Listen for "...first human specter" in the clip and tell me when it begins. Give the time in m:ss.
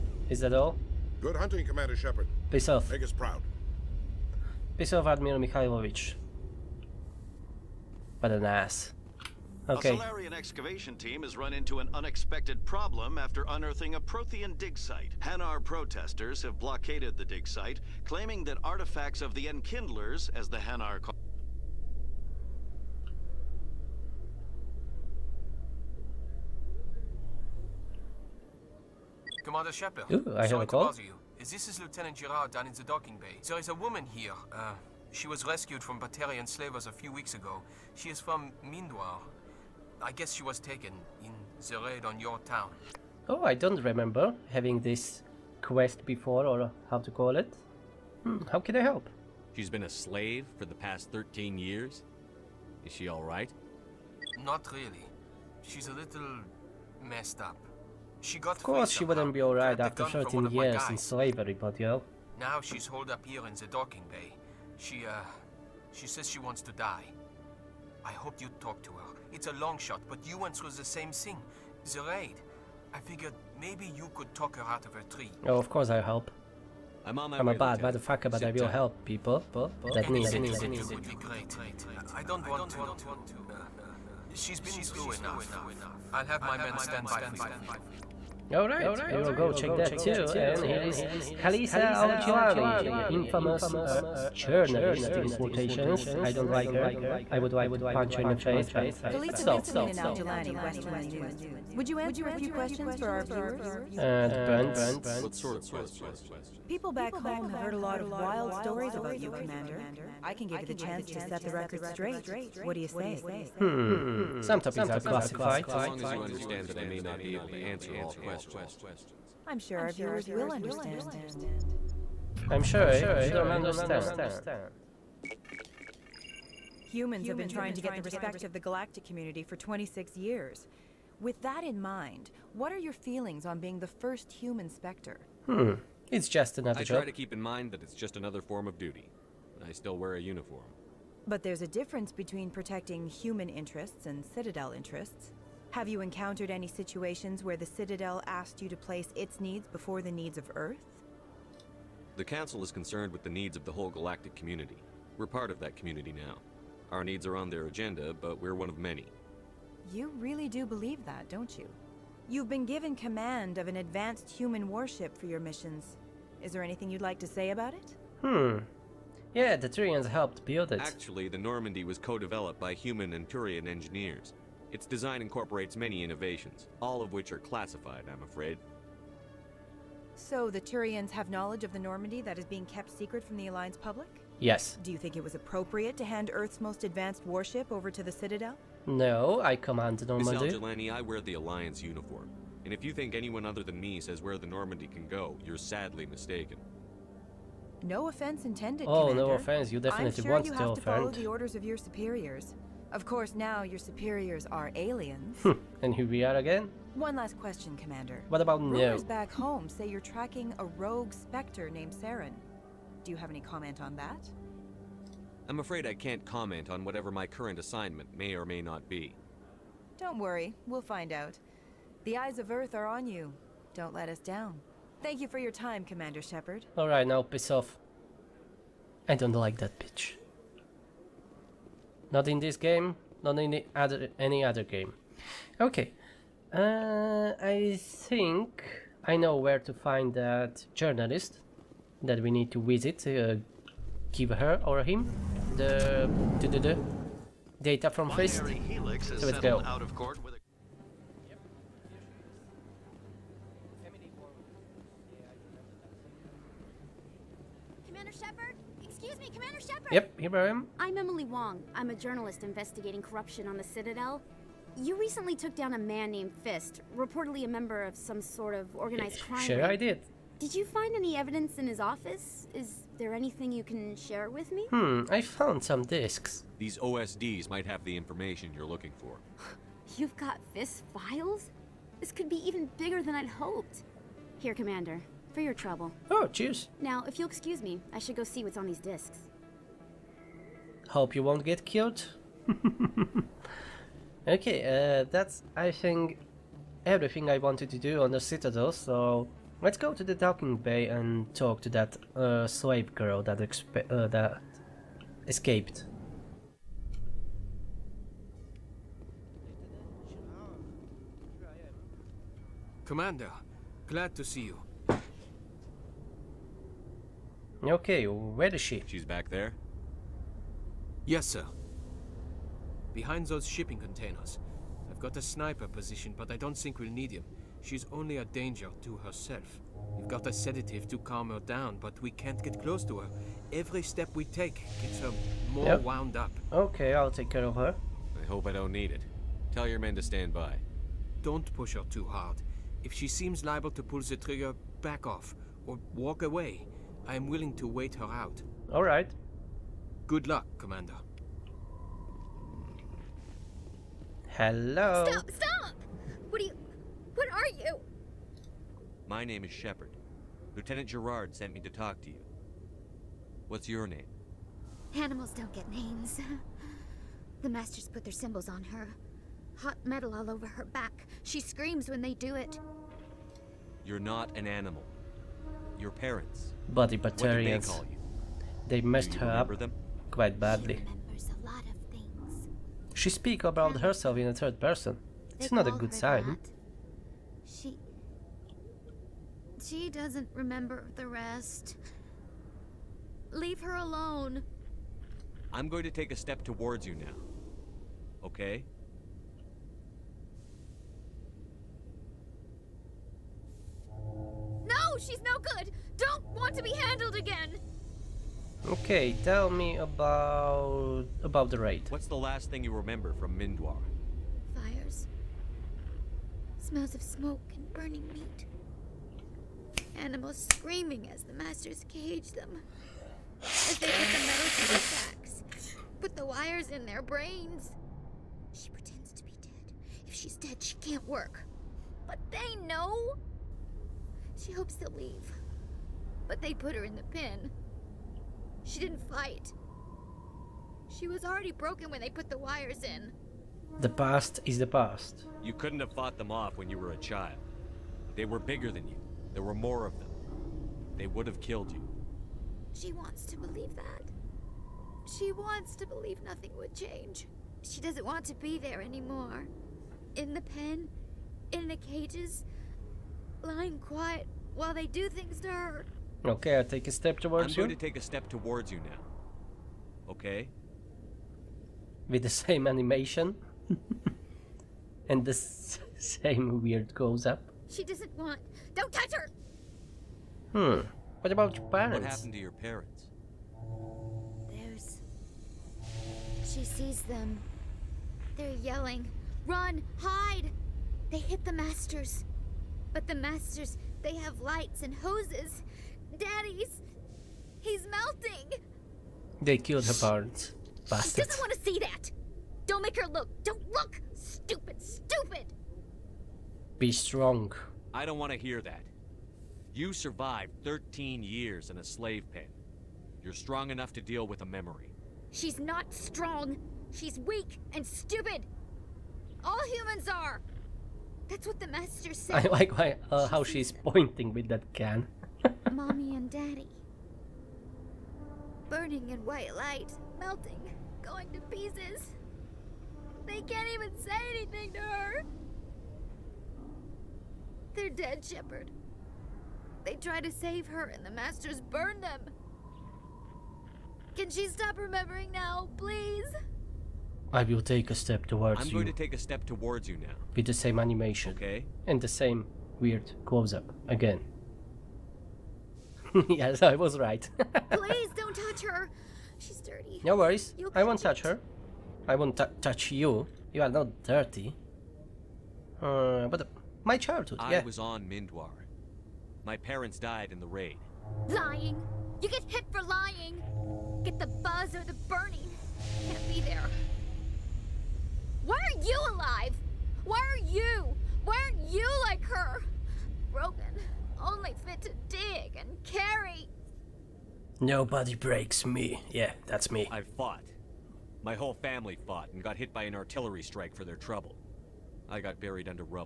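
2:13.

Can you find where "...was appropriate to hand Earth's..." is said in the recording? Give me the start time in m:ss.
3:05.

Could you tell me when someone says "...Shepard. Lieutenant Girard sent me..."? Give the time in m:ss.
5:59.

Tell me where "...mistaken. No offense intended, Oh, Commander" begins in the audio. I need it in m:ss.
3:16.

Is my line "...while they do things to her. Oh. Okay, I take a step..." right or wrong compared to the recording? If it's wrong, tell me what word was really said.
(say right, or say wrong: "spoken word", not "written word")
right.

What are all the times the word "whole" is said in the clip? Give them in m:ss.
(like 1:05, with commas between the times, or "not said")
2:33, 9:51.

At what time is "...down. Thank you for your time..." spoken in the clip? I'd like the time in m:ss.
3:44.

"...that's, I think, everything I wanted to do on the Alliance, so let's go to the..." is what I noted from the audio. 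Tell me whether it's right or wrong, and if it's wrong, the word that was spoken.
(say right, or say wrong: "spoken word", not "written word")
wrong: "Citadel", not "Alliance".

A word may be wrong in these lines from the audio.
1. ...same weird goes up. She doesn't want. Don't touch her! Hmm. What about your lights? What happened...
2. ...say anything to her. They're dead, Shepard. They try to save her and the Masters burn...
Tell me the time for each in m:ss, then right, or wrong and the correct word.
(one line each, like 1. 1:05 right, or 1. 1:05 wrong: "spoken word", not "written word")
1. 7:55 wrong: "parents", not "lights"
2. 8:54 right.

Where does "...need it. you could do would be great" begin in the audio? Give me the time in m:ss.
1:20.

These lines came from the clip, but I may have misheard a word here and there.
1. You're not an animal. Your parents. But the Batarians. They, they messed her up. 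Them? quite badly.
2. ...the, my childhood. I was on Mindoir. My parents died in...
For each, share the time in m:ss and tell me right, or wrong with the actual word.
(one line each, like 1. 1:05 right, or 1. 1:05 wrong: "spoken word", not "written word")
1. 6:13 right
2. 9:26 right.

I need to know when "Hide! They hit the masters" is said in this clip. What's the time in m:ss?
8:09.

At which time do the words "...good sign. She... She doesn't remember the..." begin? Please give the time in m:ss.
6:25.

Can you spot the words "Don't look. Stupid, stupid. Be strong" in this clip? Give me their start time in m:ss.
8:23.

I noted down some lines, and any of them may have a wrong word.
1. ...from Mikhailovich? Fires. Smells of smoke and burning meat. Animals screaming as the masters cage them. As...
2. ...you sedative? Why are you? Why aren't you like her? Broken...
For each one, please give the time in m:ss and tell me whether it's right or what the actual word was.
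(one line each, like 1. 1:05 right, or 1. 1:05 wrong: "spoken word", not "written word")
1. 6:53 wrong: "Mindoir", not "Mikhailovich"
2. 9:38 wrong: "alive", not "sedative".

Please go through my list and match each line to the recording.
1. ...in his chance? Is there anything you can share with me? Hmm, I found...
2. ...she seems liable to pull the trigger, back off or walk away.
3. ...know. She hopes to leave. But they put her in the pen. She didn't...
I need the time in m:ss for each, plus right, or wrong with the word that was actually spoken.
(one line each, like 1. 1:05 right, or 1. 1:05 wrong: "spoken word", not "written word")
1. 4:31 wrong: "office", not "chance"
2. 5:42 right
3. 7:12 right.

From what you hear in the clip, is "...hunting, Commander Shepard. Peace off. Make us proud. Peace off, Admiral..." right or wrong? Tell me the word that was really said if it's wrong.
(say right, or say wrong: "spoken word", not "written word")
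right.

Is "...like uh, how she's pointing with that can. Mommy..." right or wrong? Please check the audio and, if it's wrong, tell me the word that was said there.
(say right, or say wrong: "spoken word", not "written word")
right.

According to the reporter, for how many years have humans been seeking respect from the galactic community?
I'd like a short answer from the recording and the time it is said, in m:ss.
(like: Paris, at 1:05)
26, at 2:09.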